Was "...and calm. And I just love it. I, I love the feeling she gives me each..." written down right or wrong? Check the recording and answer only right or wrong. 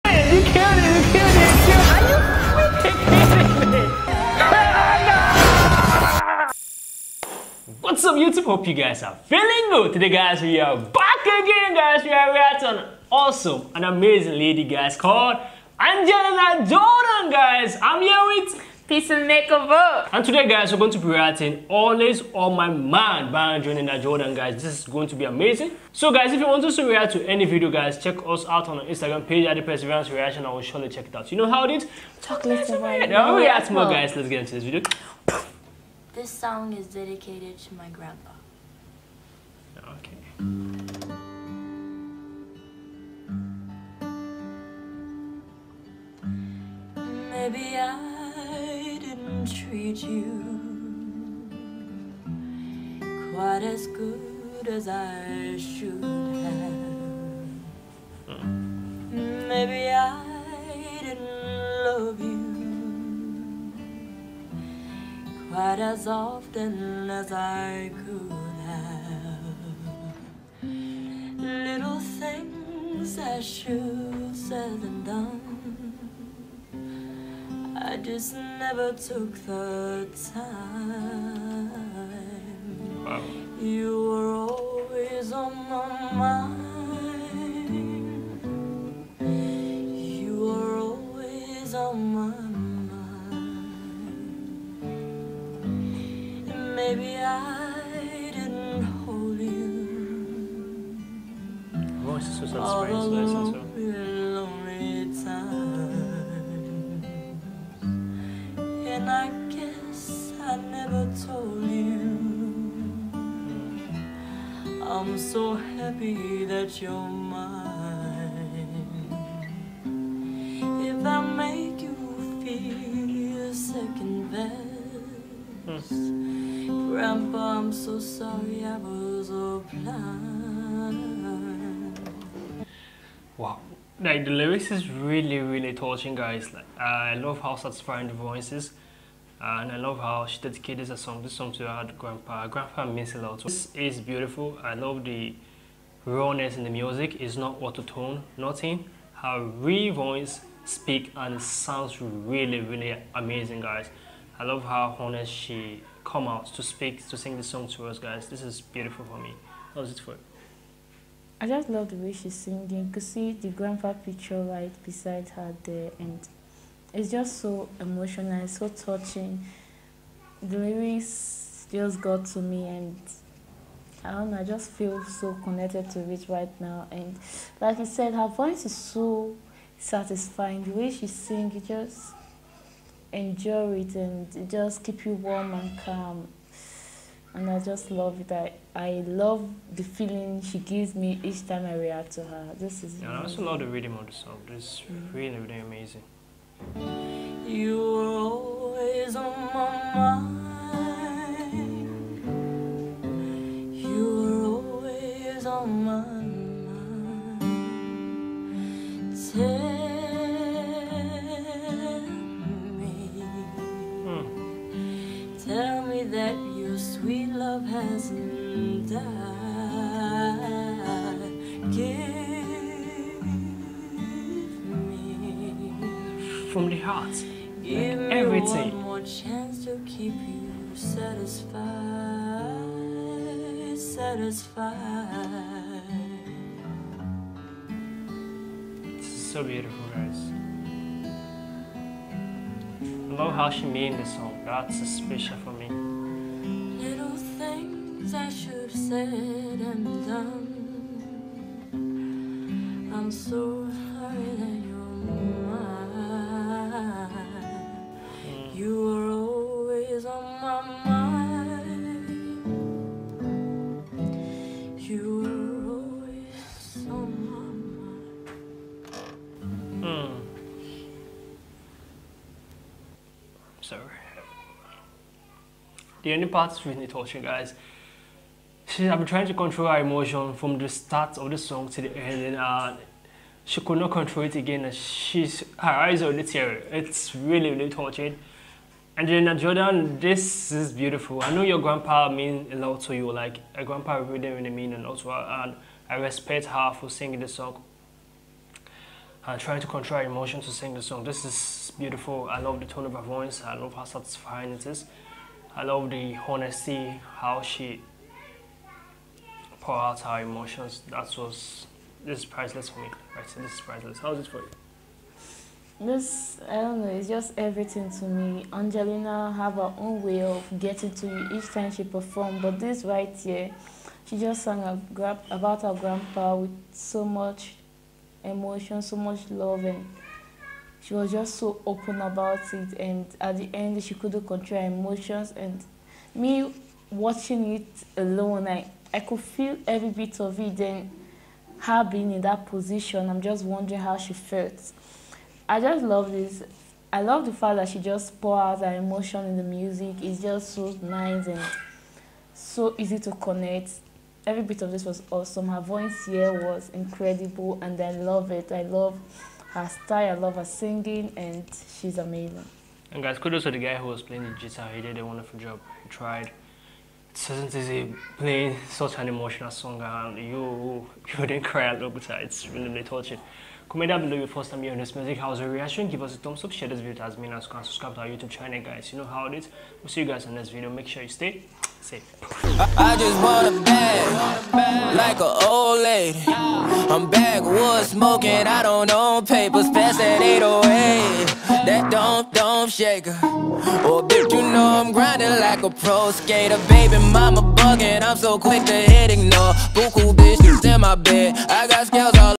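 right.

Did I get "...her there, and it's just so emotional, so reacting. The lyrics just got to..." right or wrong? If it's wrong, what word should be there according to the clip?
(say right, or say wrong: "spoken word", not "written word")
wrong: "touching", not "reacting".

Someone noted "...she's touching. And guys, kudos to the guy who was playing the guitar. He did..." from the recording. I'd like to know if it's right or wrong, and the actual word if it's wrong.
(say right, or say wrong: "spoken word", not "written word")
wrong: "amazing", not "touching".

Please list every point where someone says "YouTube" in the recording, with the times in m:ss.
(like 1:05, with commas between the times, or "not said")
0:08, 6:18.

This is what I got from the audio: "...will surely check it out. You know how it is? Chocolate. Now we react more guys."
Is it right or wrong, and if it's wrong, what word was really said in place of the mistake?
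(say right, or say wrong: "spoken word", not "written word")
right.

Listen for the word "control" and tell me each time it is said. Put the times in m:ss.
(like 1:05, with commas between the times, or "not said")
4:39, 4:43, 4:59, 5:34.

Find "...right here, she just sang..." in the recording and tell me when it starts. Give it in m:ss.
5:22.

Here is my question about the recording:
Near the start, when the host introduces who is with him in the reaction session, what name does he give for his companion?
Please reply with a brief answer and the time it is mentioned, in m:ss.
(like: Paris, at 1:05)
Peace and Makeover, at 0:18.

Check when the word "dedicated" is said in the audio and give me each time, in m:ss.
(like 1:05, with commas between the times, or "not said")
0:36, 2:20.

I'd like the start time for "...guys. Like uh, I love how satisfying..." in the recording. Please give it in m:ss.
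2:16.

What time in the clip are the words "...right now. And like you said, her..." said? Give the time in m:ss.
2:56.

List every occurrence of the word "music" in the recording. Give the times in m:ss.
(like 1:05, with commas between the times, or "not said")
2:26, 5:49, 6:14.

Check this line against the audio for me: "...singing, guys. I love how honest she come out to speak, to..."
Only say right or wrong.
wrong.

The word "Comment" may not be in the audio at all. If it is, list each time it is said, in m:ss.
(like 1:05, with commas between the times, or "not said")
6:13.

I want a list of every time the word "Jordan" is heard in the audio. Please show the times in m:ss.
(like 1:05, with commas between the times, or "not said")
0:16, 0:24, 4:49.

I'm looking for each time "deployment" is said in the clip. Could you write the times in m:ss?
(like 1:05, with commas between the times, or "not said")
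not said.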